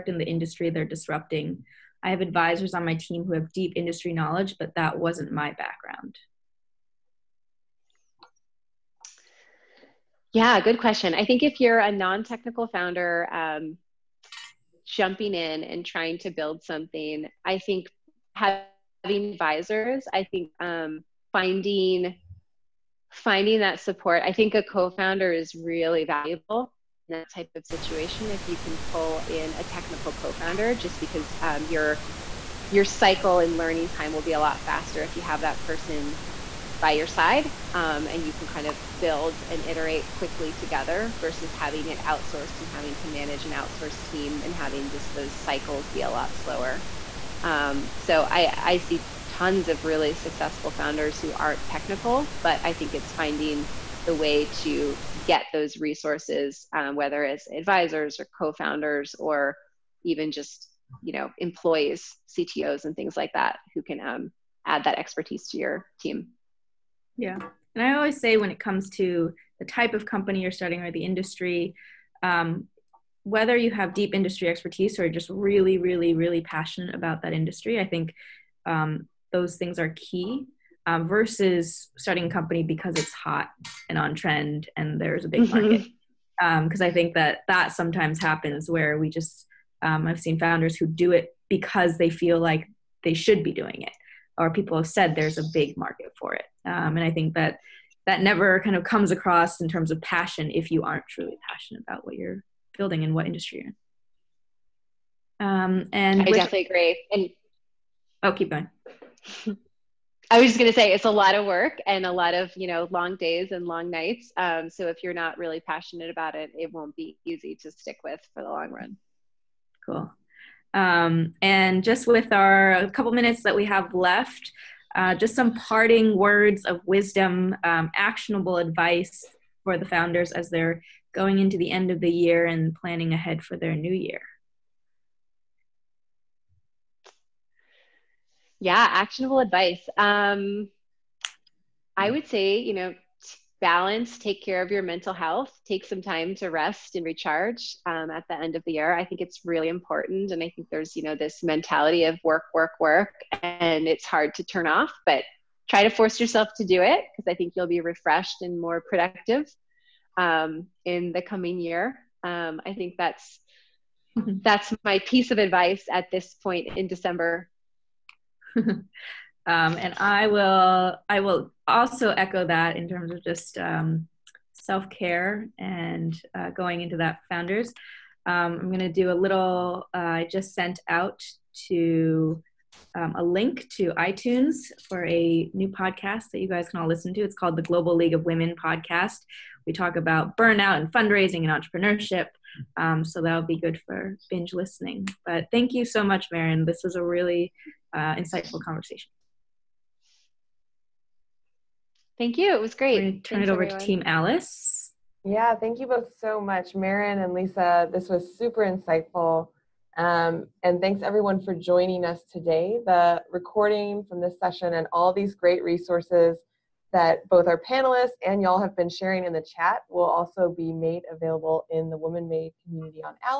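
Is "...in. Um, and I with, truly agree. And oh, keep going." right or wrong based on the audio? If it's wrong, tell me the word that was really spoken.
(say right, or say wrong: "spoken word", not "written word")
wrong: "definitely", not "truly".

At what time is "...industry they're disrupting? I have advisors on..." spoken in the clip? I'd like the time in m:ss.
0:00.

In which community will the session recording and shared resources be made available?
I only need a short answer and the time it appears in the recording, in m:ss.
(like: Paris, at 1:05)
WomanMade community, at 3:41.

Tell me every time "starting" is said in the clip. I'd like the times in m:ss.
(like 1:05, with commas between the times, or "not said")
1:10, 1:21.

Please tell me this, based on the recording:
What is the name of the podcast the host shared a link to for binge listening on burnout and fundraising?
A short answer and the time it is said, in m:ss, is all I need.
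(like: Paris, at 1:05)
Global League of Women podcast, at 3:07.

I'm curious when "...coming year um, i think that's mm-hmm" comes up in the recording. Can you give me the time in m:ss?
2:41.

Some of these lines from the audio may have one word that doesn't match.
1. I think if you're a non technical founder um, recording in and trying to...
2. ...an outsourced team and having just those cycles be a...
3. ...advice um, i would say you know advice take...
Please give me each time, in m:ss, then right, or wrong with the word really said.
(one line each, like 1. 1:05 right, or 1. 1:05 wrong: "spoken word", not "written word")
1. 0:11 wrong: "jumping", not "recording"
2. 0:43 right
3. 2:19 wrong: "balance", not "advice".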